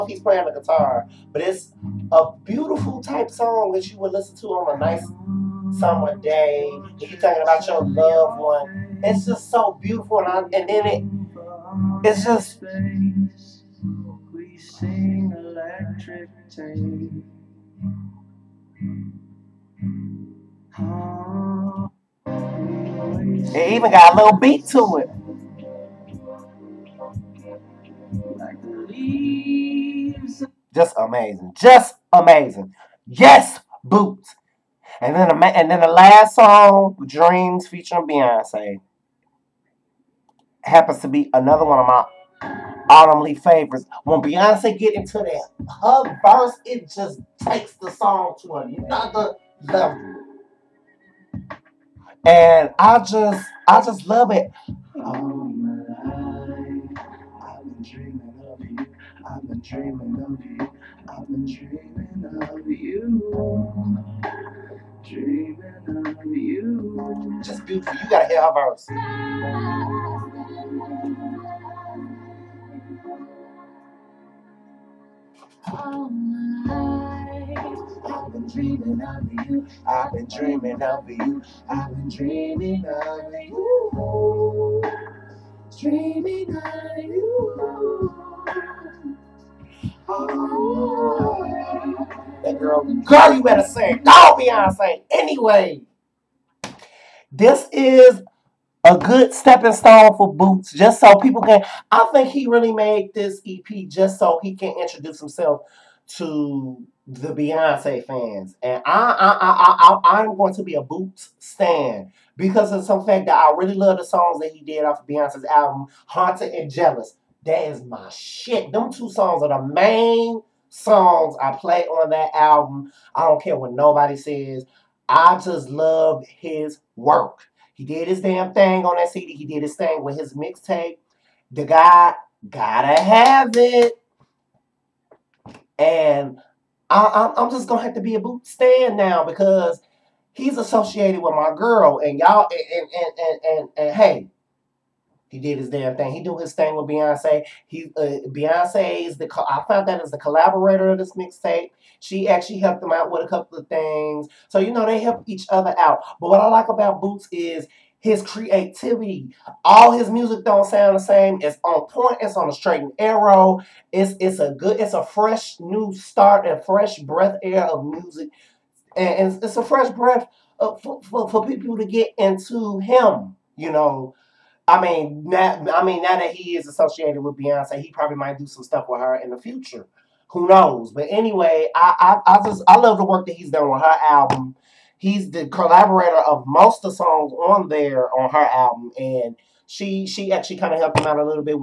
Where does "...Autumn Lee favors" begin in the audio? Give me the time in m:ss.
0:42.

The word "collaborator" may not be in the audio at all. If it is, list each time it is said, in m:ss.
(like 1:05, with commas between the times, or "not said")
2:30, 3:05.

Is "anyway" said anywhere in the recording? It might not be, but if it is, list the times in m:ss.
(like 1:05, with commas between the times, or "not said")
1:35, 3:01.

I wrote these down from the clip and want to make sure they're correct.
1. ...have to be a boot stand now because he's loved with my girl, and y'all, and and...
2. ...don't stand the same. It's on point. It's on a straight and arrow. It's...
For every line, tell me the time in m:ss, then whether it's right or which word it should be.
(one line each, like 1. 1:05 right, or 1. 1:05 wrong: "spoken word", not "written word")
1. 2:17 wrong: "associated", not "loved"
2. 2:40 wrong: "sound", not "stand".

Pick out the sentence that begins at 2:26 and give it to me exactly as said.
He do his thing with Beyonce.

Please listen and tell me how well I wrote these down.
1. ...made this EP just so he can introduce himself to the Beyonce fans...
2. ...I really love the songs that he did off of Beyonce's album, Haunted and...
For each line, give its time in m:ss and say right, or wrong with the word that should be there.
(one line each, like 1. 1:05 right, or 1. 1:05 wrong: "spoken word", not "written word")
1. 1:42 right
2. 1:53 right.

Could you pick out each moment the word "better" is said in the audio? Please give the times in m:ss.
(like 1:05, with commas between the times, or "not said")
1:33.